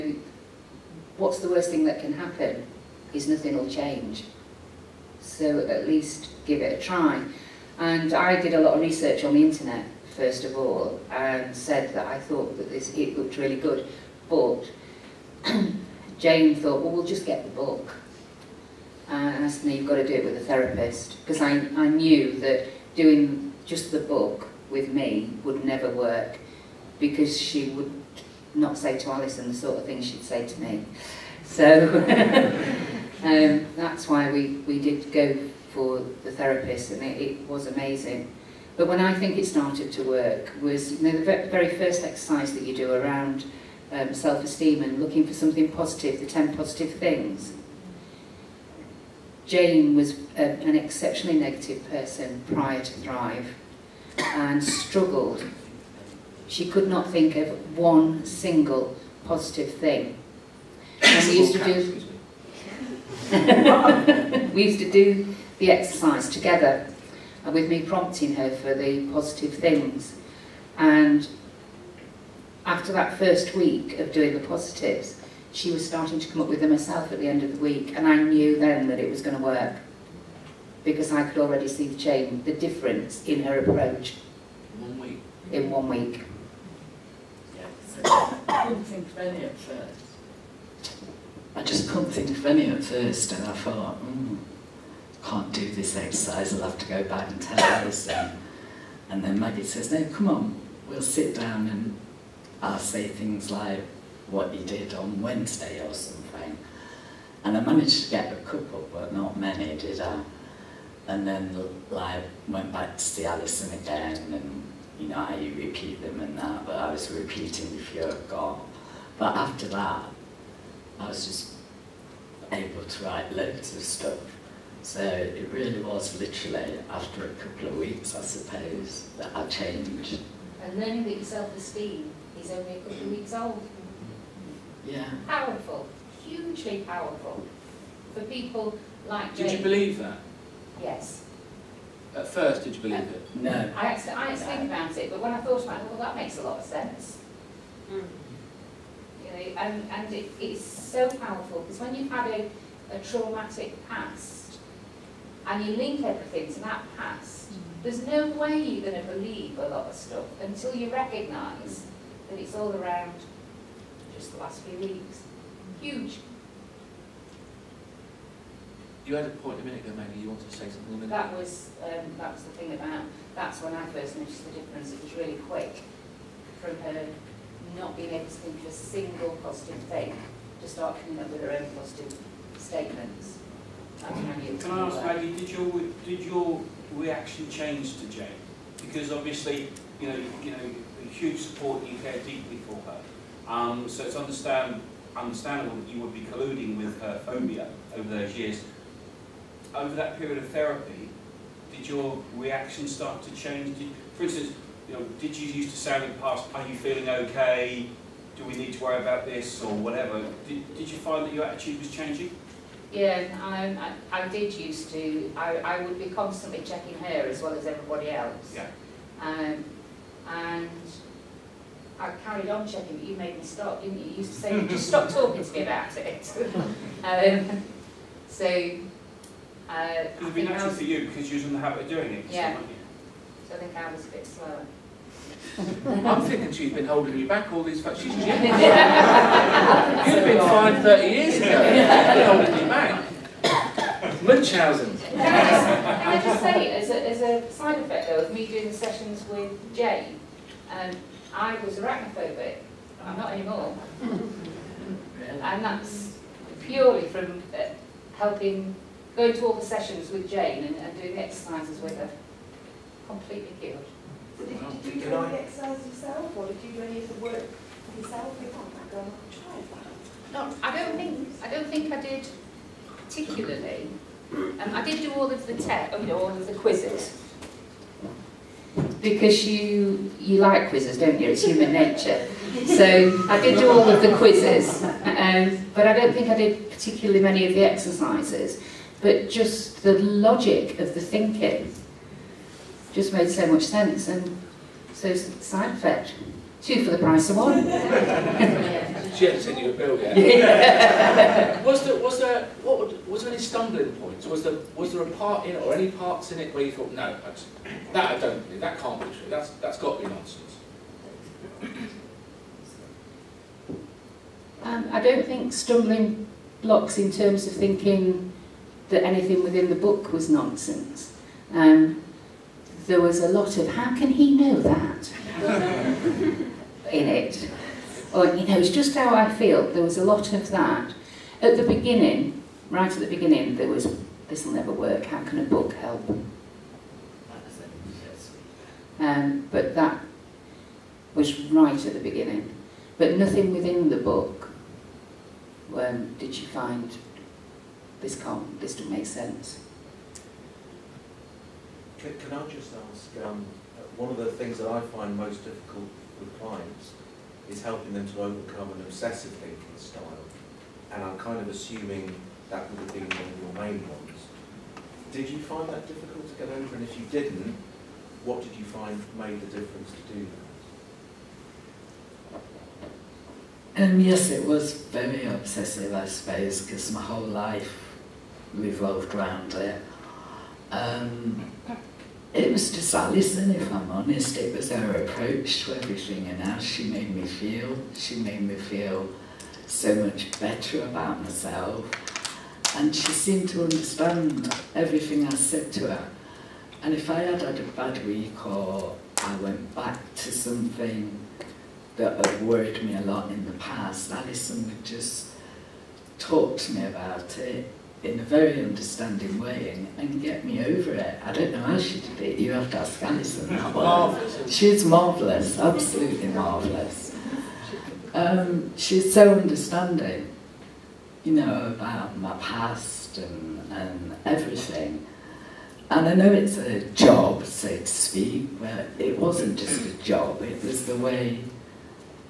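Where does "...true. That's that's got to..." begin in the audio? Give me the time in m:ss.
5:09.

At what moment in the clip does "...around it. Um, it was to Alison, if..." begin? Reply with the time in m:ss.
6:19.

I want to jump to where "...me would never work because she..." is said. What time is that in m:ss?
0:24.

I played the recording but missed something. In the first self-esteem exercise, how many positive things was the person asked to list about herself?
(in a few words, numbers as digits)
10.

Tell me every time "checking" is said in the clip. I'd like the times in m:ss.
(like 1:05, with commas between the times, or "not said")
3:36, 3:42.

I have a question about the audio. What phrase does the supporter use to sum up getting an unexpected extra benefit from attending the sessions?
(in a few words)
two for the price of one.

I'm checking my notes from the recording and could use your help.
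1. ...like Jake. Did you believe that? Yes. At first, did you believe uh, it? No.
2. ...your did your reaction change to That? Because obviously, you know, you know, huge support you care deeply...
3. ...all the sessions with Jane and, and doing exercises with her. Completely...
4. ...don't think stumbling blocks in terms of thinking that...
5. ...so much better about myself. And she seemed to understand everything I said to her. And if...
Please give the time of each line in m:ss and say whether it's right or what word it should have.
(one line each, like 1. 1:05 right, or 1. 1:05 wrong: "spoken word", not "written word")
1. 2:19 right
2. 3:05 wrong: "Jane", not "That"
3. 4:19 right
4. 5:15 right
5. 6:29 right.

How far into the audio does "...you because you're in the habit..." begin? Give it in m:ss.
3:50.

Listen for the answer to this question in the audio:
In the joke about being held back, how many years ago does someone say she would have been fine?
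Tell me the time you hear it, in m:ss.
4:00.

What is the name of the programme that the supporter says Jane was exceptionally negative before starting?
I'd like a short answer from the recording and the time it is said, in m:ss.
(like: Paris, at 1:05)
Thrive, at 0:52.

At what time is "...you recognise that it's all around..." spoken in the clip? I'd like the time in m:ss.
2:40.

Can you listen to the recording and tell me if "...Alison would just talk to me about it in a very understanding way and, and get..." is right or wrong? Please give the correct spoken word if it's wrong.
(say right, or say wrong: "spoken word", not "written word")
right.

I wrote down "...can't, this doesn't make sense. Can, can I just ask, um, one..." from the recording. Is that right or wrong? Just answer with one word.
right.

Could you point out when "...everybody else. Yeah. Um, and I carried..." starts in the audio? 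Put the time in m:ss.
3:37.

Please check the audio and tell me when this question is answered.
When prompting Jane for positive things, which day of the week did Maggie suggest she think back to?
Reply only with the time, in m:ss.
1:45.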